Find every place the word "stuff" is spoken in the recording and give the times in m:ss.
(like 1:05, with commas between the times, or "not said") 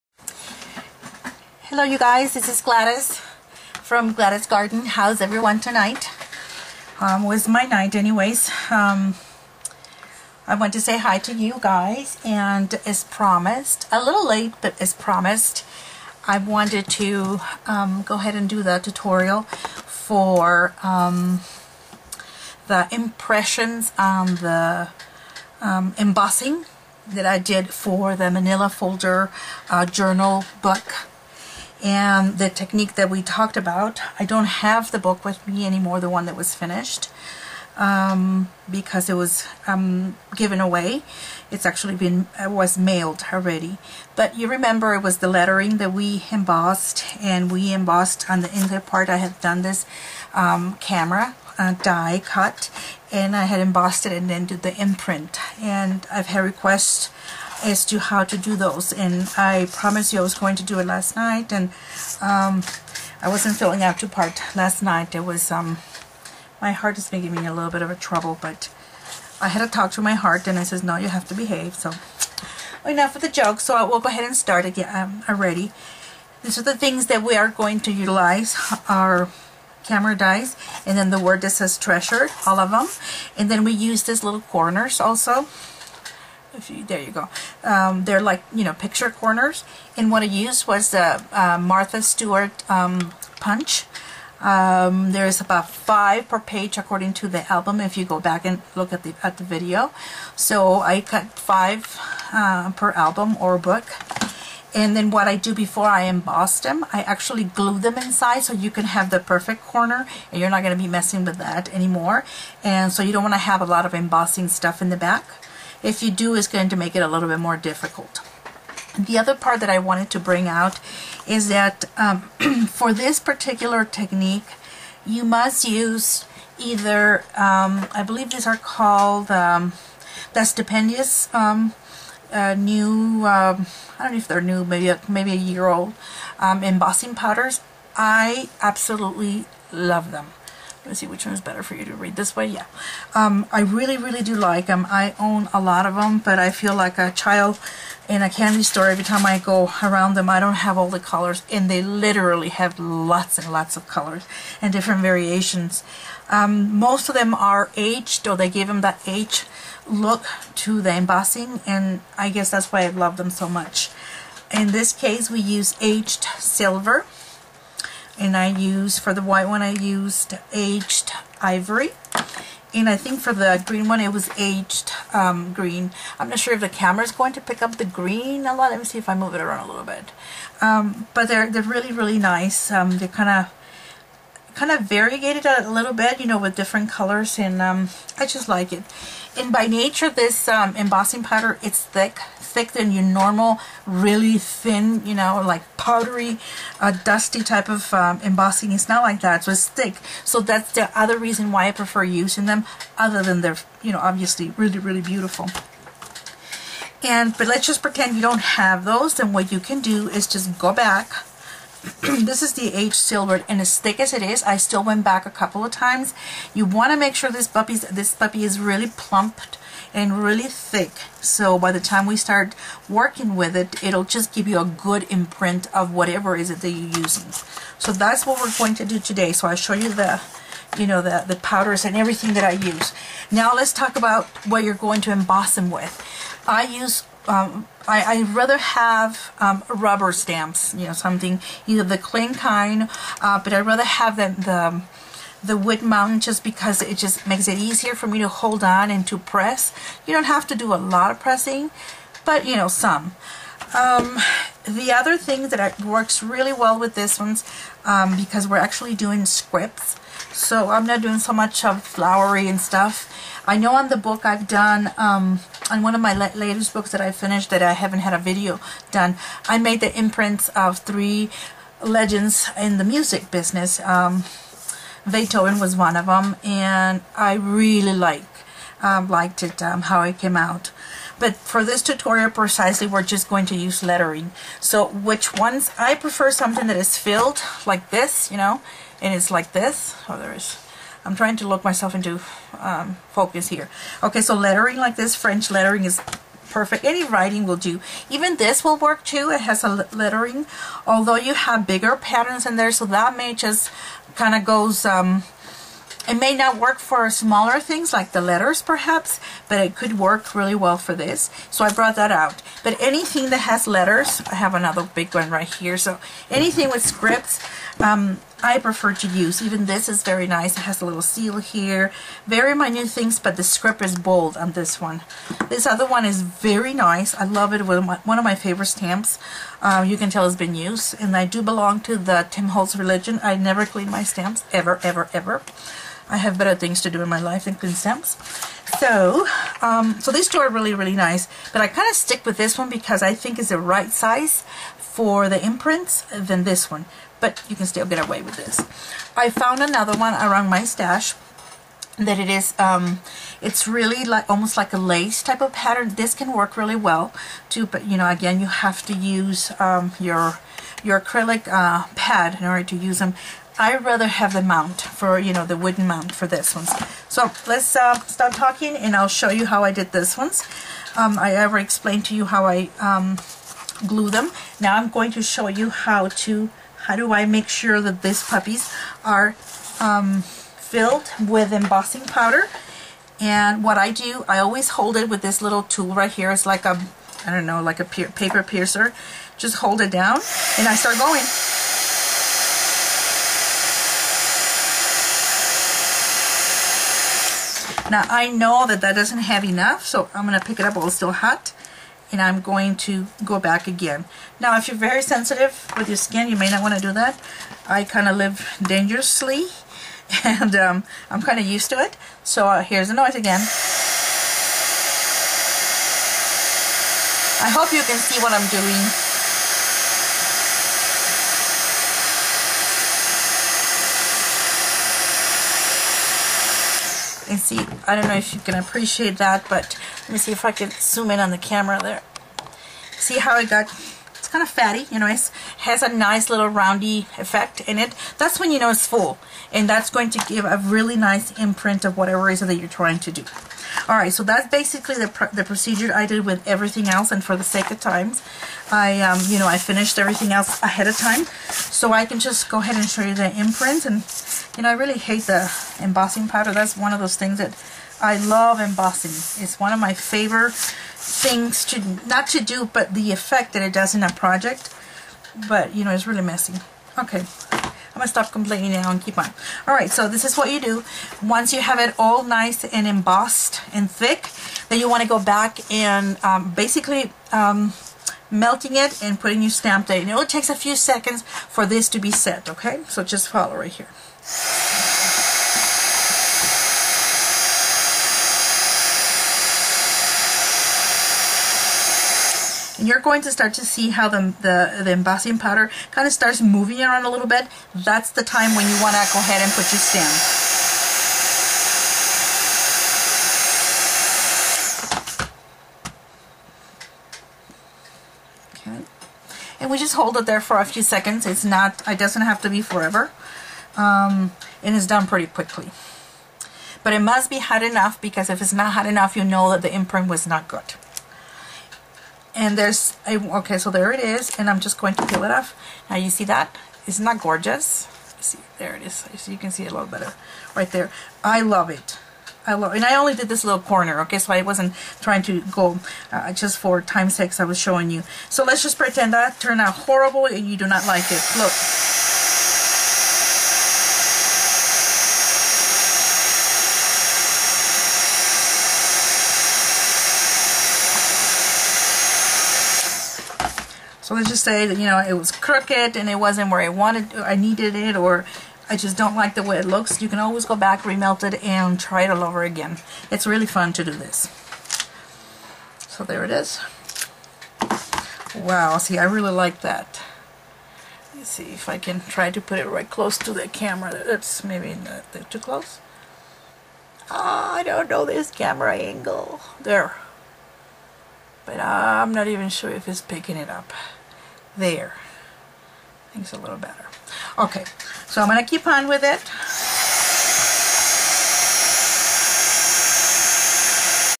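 1:54, 4:22.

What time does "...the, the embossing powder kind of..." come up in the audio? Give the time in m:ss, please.
8:14.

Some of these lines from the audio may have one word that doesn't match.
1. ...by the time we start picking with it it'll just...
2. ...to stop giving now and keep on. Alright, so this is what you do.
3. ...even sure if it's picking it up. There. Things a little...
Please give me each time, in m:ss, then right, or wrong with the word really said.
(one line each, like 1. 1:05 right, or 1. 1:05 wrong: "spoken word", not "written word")
1. 3:41 wrong: "working", not "picking"
2. 7:48 wrong: "complaining", not "giving"
3. 9:42 right.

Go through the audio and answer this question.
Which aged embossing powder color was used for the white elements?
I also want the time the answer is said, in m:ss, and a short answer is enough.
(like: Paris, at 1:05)
Aged ivory, at 2:50.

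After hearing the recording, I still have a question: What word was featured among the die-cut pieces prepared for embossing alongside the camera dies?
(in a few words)
Treasure.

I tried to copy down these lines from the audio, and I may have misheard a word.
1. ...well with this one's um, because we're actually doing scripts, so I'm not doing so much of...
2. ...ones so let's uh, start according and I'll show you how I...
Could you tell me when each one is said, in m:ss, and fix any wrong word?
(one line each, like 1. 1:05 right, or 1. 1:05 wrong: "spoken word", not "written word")
1. 4:16 right
2. 6:06 wrong: "talking", not "according".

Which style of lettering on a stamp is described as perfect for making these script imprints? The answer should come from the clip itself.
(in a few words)
French lettering.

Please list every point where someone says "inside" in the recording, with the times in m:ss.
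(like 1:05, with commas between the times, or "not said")
0:48, 1:47.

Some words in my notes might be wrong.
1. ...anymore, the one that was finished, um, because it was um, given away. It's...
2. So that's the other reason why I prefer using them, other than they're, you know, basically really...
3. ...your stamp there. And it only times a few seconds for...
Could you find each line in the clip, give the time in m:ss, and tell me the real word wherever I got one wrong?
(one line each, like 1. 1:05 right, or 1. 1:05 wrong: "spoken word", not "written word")
1. 0:35 right
2. 3:20 wrong: "obviously", not "basically"
3. 7:59 wrong: "takes", not "times".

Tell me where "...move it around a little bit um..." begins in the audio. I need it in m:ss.
2:59.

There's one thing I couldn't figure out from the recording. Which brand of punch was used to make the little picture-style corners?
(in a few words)
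Martha Stewart.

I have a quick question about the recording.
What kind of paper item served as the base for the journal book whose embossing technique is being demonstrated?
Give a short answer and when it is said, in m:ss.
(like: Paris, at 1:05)
Manila folder, at 0:28.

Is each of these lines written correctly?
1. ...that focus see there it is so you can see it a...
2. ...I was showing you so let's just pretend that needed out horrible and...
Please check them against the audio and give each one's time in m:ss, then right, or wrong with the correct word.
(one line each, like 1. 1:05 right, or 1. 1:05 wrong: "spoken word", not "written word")
1. 8:47 wrong: "gorgeous", not "focus"
2. 8:57 wrong: "turned", not "needed".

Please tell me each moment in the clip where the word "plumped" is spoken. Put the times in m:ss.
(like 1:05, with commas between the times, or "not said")
3:38.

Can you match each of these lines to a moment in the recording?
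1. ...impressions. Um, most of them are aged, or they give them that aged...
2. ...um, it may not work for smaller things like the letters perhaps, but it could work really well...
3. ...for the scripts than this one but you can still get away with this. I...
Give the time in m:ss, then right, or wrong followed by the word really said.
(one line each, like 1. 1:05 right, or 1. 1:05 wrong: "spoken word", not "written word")
1. 2:35 wrong: "variations", not "impressions"
2. 5:04 right
3. 5:44 wrong: "imprints", not "scripts".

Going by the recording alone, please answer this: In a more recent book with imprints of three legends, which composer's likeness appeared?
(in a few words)
Beethoven.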